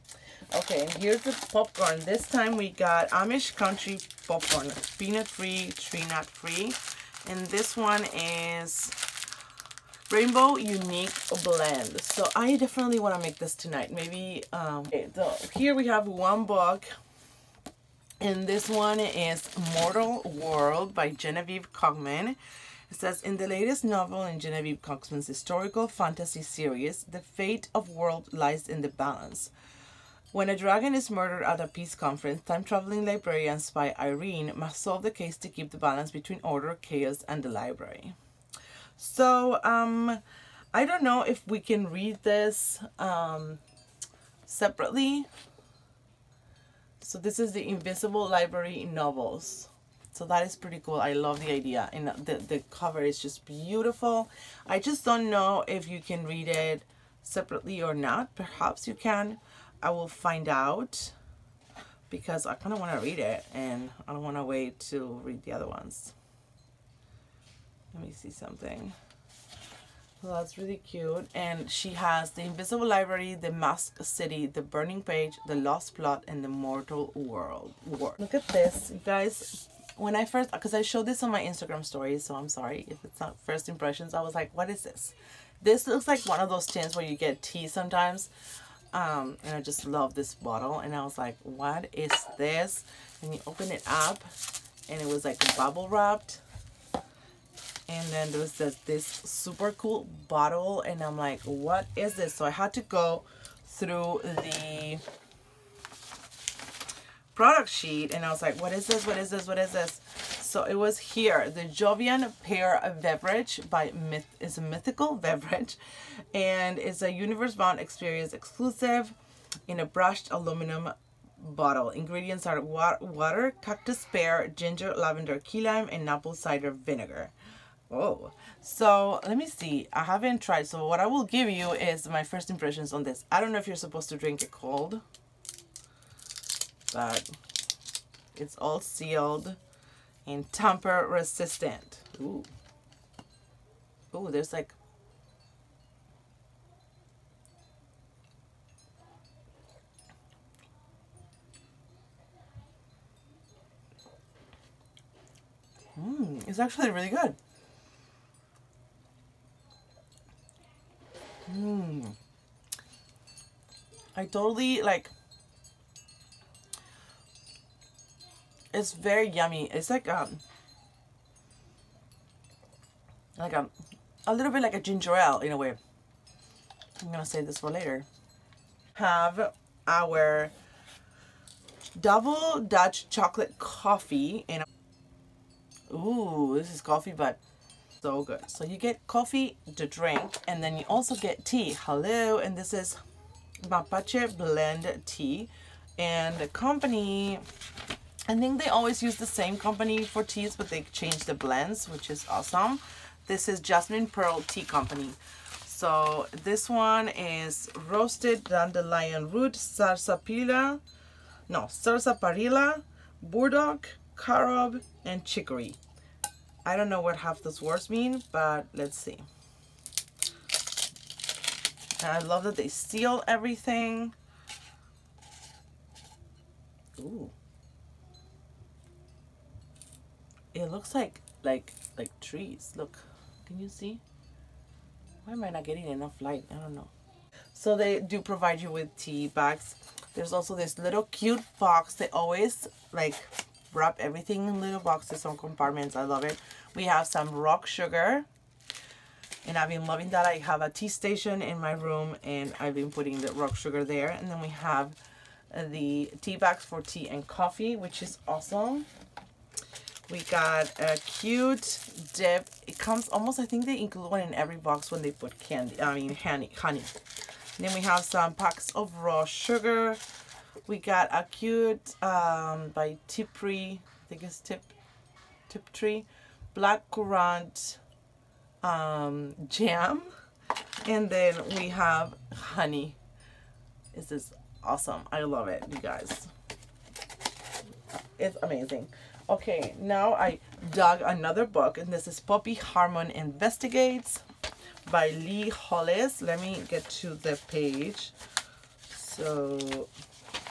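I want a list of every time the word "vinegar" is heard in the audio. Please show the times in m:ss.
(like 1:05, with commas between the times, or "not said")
2:06.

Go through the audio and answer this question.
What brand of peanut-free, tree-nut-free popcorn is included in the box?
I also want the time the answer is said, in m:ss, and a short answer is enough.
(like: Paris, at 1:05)
Amish Country Popcorn, at 0:03.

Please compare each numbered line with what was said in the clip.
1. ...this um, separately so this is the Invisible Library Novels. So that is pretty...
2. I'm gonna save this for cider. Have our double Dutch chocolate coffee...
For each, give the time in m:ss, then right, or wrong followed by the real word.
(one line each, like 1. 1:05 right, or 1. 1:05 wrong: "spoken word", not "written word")
1. 0:42 right
2. 2:57 wrong: "later", not "cider".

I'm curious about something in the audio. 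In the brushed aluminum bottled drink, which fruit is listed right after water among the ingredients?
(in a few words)
cactus pear.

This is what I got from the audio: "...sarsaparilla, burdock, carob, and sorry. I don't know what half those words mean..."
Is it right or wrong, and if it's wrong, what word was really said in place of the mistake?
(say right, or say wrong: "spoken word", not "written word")
wrong: "chicory", not "sorry".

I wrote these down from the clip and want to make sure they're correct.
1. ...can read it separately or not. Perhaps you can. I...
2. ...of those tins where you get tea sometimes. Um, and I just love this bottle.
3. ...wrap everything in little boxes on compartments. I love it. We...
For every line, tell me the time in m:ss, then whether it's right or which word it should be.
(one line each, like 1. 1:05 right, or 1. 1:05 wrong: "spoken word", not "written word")
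1. 0:56 right
2. 1:26 right
3. 4:03 right.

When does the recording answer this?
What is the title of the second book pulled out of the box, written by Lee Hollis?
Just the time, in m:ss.
4:52.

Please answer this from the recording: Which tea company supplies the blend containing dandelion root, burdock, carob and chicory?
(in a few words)
Jasmine Pearl Tea Company.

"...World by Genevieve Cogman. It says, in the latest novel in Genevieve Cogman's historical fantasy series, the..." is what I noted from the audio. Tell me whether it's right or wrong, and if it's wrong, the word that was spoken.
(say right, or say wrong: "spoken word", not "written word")
right.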